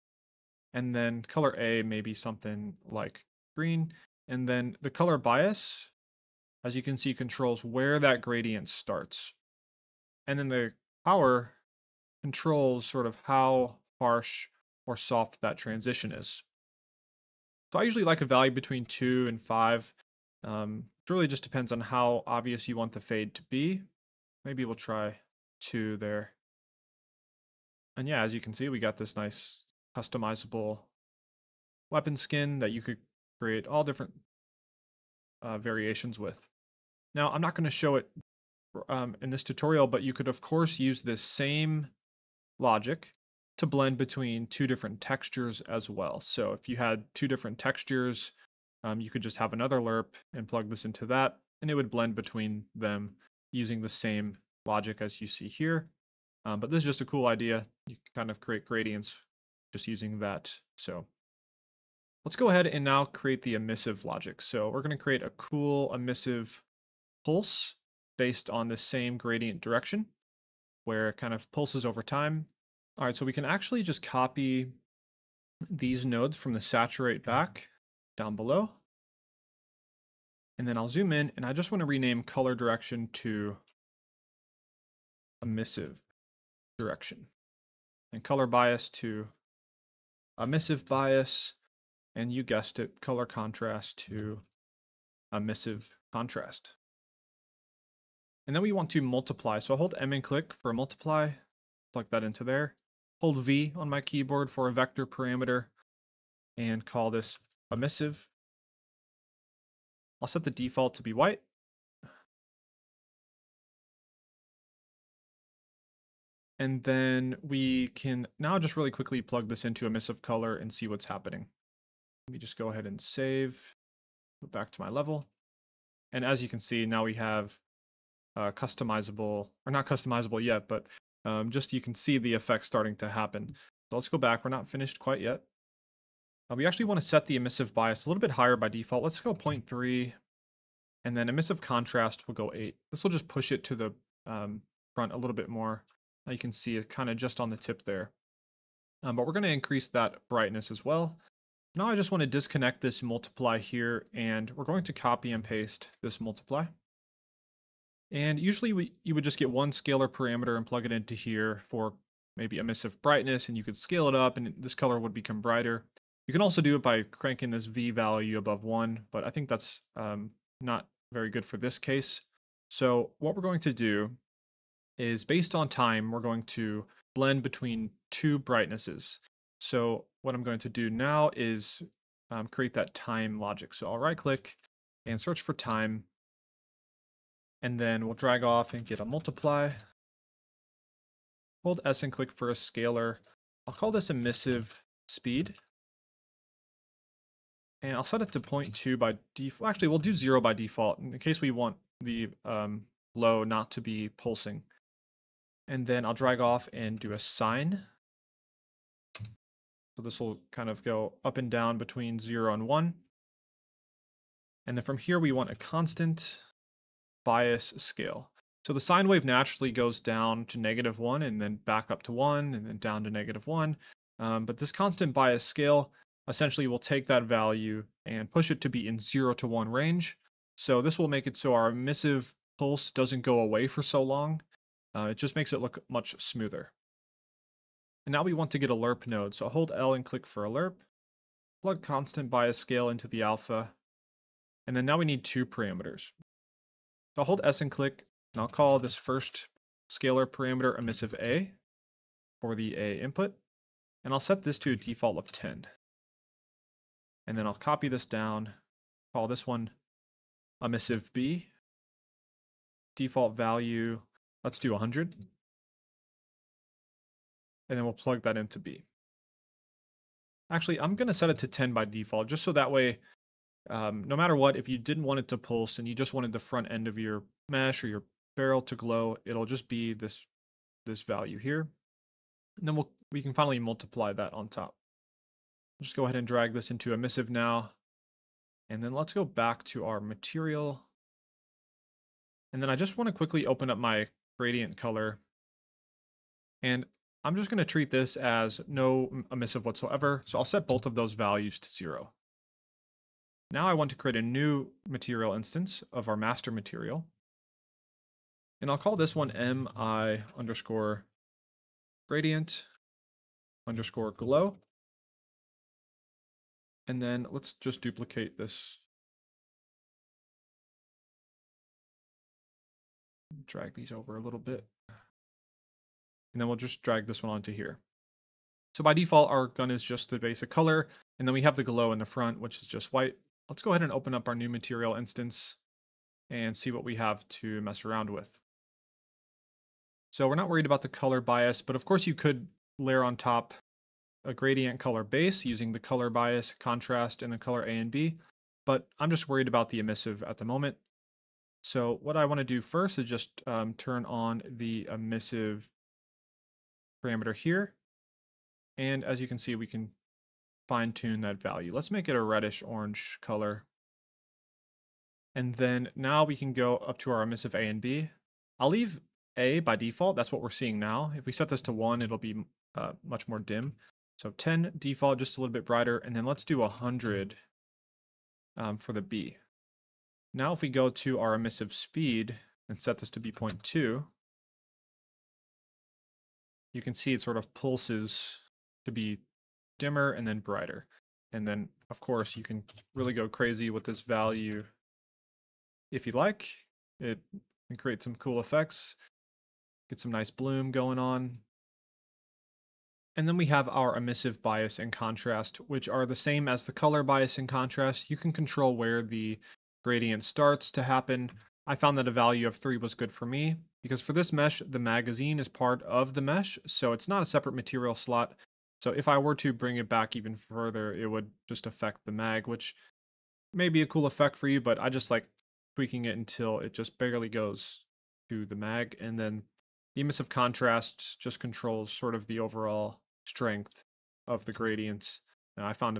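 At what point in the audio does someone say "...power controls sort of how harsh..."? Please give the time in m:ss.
0:11.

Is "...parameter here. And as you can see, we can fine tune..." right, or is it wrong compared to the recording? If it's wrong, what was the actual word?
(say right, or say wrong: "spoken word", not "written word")
right.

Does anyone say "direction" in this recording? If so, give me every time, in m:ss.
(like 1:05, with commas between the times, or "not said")
1:09, 1:22, 1:26.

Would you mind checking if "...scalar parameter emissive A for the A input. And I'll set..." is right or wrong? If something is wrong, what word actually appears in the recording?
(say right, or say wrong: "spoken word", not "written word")
right.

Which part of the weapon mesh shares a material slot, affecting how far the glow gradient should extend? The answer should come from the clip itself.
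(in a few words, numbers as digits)
the magazine.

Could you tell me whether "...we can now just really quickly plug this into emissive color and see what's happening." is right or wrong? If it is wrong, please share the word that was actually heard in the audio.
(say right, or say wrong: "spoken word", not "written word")
right.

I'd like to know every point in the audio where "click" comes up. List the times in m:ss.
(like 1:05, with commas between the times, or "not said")
1:40, 3:04, 3:12, 4:00, 4:07.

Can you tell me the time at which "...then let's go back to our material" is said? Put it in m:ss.
4:48.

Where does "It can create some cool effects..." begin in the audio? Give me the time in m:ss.
6:36.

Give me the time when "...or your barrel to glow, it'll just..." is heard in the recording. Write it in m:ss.
4:37.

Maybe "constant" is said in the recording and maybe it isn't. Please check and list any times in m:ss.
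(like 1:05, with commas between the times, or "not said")
3:35, 3:44, 4:01.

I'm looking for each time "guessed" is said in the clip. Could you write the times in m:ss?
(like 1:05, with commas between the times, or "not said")
1:32.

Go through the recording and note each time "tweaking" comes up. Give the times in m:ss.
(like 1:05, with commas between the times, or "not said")
7:05.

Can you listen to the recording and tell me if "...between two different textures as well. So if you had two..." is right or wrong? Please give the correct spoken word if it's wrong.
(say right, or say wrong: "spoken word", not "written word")
right.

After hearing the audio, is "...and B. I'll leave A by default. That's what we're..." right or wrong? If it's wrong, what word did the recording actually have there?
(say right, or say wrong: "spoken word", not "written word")
right.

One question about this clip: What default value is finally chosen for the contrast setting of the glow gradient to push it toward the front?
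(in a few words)
8.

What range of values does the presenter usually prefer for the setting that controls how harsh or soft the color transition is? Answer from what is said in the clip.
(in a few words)
2 to 5.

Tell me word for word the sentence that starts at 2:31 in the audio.
Now I just want to disconnect this multiply here, and we're going to copy and paste this multiply.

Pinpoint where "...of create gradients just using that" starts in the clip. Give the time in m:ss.
0:58.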